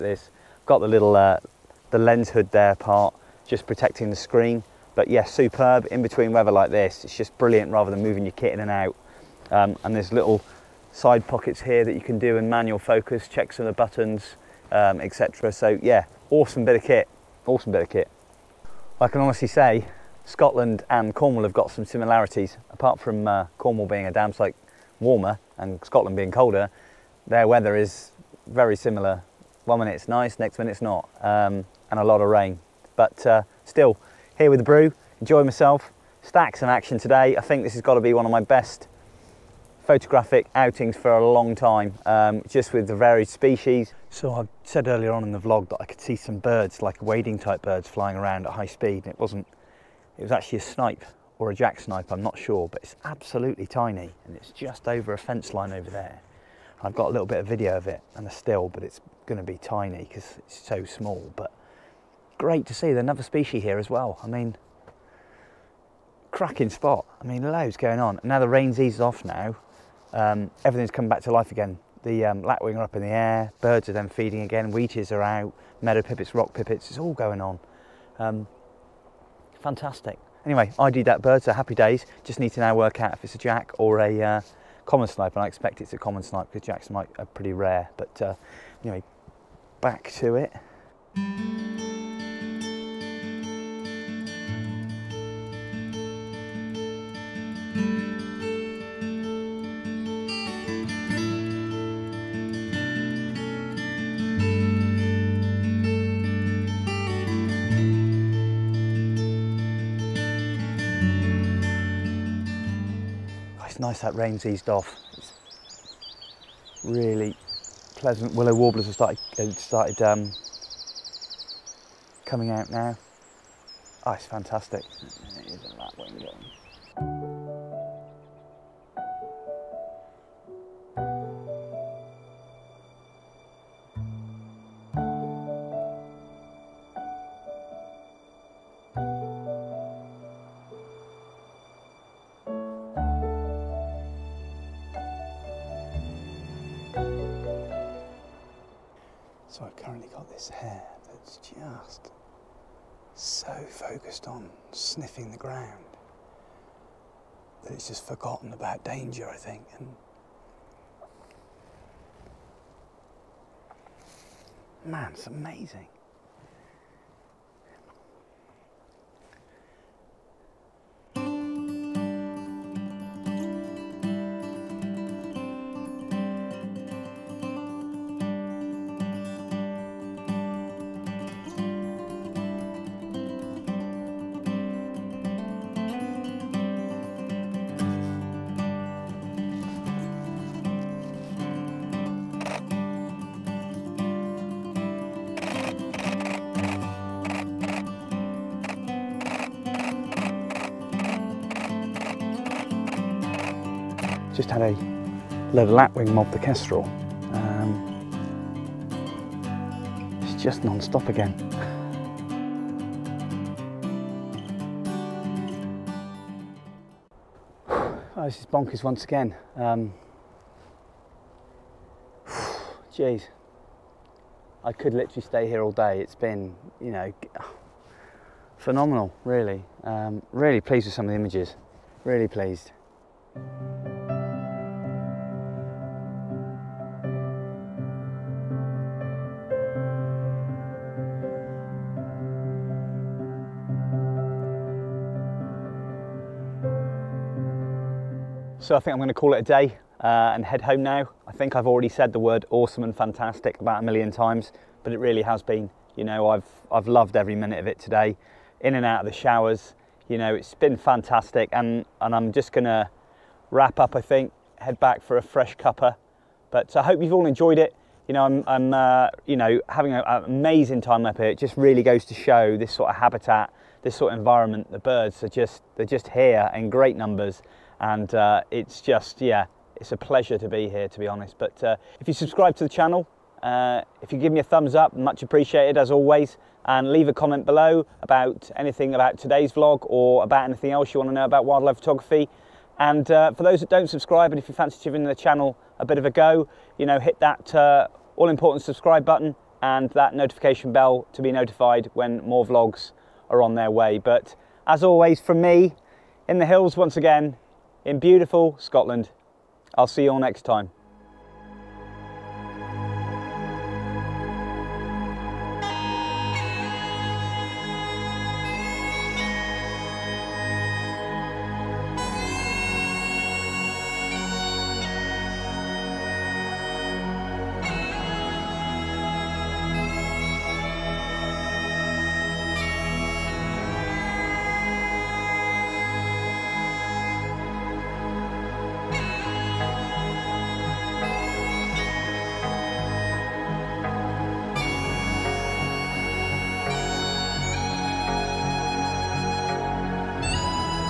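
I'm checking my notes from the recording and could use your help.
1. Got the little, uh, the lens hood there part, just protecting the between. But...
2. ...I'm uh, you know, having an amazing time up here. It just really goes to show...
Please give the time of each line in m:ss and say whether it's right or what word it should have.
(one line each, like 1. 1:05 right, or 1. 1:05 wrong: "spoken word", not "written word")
1. 0:00 wrong: "screen", not "between"
2. 4:28 right.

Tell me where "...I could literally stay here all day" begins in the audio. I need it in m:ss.
3:44.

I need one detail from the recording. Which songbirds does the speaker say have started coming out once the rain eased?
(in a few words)
Willow warblers.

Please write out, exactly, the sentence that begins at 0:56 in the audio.
I've got a little bit of video of it and a still, but it's going to be tiny because it's so small.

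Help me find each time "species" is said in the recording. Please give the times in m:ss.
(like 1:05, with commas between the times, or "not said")
0:43, 1:03.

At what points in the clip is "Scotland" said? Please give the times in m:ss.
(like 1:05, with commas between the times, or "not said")
0:20, 0:25, 5:08.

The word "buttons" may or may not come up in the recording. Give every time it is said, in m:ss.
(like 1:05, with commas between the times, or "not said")
0:13, 4:59.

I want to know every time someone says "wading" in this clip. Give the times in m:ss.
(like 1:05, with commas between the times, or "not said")
0:47.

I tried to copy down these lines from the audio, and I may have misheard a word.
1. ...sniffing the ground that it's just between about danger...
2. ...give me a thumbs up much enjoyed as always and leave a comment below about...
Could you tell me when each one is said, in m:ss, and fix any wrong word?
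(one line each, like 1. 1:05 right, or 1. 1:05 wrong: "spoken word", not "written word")
1. 2:34 wrong: "forgotten", not "between"
2. 4:44 wrong: "appreciated", not "enjoyed".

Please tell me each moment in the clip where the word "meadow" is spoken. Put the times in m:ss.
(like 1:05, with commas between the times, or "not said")
1:15.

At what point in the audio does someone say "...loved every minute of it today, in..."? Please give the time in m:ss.
4:16.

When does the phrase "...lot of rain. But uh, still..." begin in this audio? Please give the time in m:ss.
0:32.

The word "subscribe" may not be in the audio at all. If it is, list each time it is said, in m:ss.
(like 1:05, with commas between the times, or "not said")
4:42, 4:53, 4:58.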